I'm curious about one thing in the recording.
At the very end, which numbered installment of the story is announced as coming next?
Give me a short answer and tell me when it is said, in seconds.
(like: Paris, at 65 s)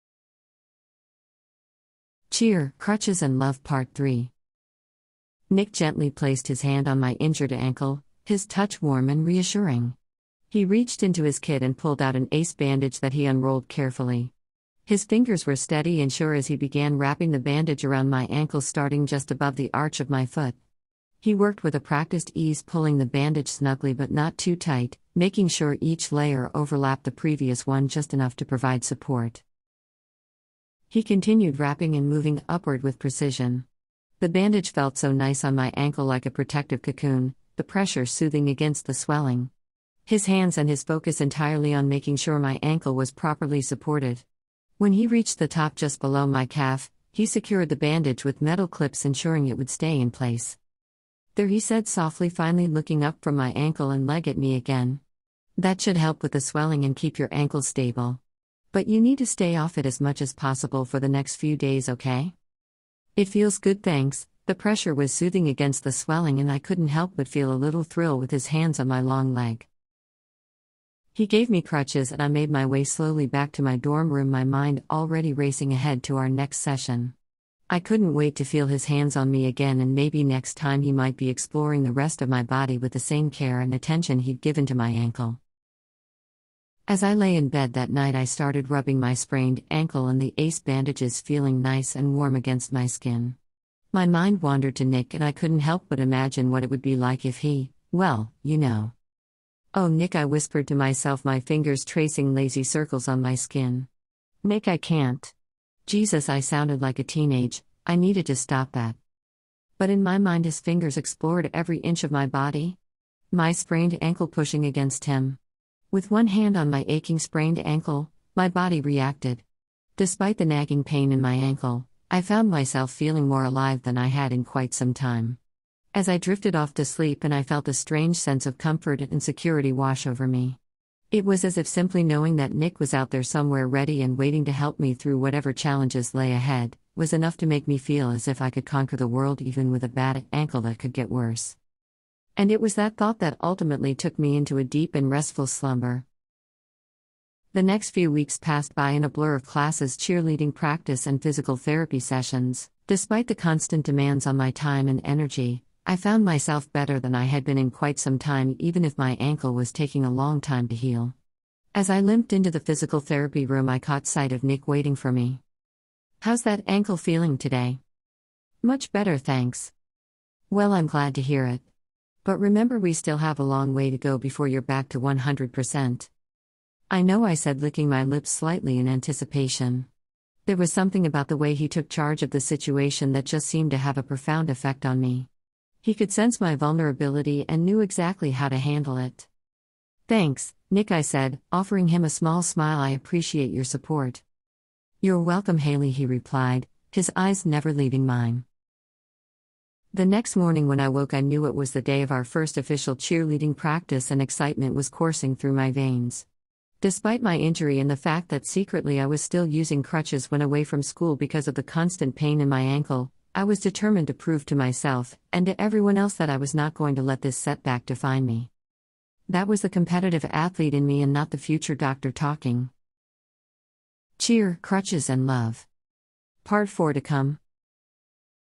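Part 4, at 226 s.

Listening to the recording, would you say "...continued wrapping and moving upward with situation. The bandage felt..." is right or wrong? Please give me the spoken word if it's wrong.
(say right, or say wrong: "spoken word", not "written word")
wrong: "precision", not "situation".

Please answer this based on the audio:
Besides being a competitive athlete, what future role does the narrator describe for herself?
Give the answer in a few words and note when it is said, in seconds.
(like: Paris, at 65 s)
future doctor, at 221 s.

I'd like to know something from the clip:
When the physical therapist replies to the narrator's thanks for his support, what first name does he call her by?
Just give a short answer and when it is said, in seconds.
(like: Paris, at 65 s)
Haley, at 195 s.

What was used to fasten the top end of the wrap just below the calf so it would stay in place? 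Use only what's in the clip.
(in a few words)
metal clips.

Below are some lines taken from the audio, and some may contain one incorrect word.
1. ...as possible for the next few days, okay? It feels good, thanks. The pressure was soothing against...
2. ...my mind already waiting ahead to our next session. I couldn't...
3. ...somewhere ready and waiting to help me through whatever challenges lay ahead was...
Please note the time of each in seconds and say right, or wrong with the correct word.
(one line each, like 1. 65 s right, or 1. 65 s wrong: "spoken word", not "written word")
1. 60 s right
2. 74 s wrong: "racing", not "waiting"
3. 133 s right.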